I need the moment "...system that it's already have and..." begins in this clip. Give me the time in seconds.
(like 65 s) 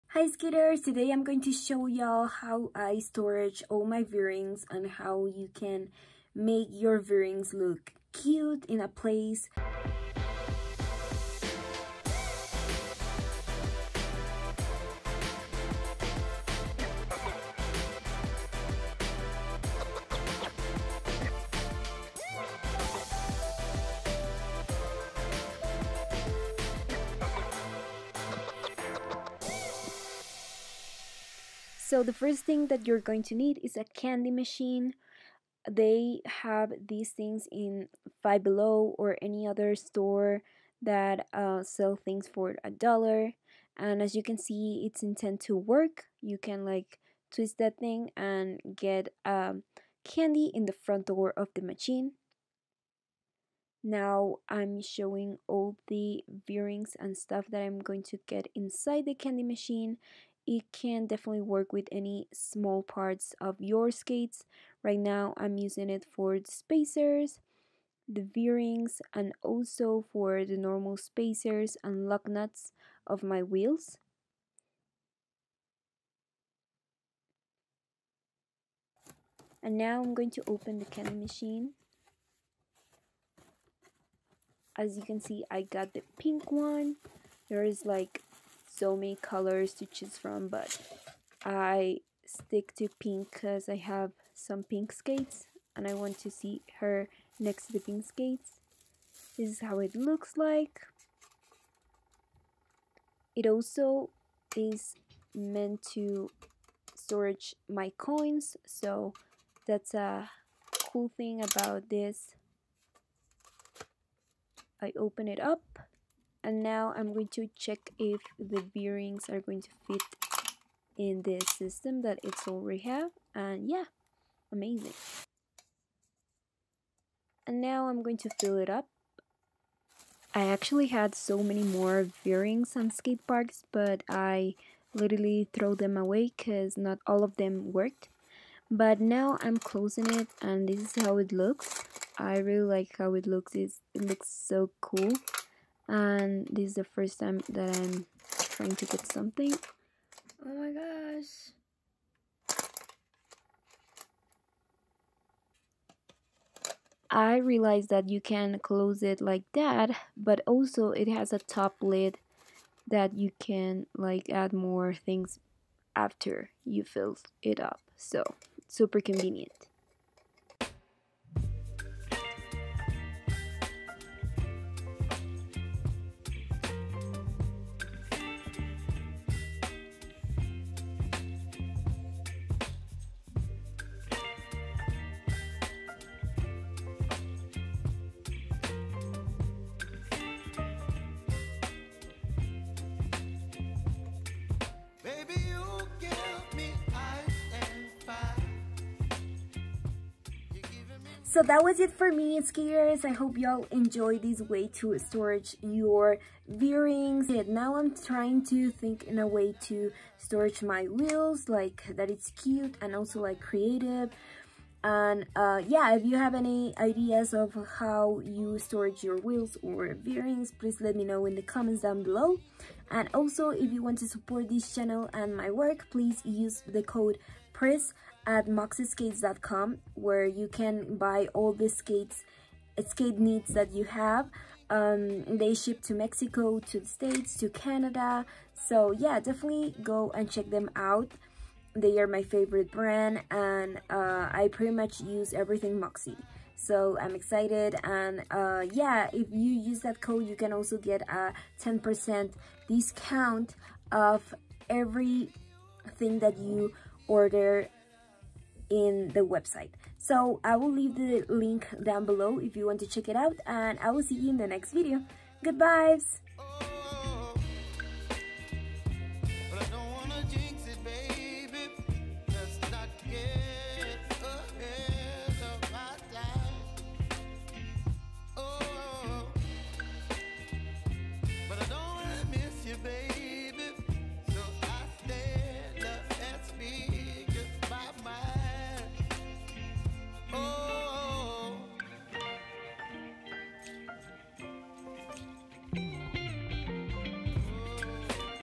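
121 s.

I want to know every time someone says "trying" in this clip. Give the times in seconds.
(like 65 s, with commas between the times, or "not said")
148 s, 207 s.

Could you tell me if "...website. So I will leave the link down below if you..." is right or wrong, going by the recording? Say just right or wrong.
right.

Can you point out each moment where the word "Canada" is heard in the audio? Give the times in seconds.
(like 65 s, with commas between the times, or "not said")
237 s.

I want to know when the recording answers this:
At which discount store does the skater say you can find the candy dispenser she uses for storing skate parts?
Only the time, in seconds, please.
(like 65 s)
38 s.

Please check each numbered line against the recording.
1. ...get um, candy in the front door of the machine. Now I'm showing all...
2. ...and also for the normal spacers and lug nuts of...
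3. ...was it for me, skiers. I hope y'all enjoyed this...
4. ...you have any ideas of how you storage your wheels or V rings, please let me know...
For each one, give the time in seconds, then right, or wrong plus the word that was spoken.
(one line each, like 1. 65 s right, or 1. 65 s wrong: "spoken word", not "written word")
1. 48 s right
2. 69 s right
3. 201 s right
4. 216 s right.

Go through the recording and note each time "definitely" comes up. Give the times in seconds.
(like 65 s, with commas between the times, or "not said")
61 s, 239 s.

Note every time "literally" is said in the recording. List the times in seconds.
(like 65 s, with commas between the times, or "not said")
134 s.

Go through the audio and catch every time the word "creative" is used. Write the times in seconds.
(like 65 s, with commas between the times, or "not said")
213 s.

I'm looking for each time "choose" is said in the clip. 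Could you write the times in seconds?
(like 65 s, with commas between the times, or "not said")
89 s.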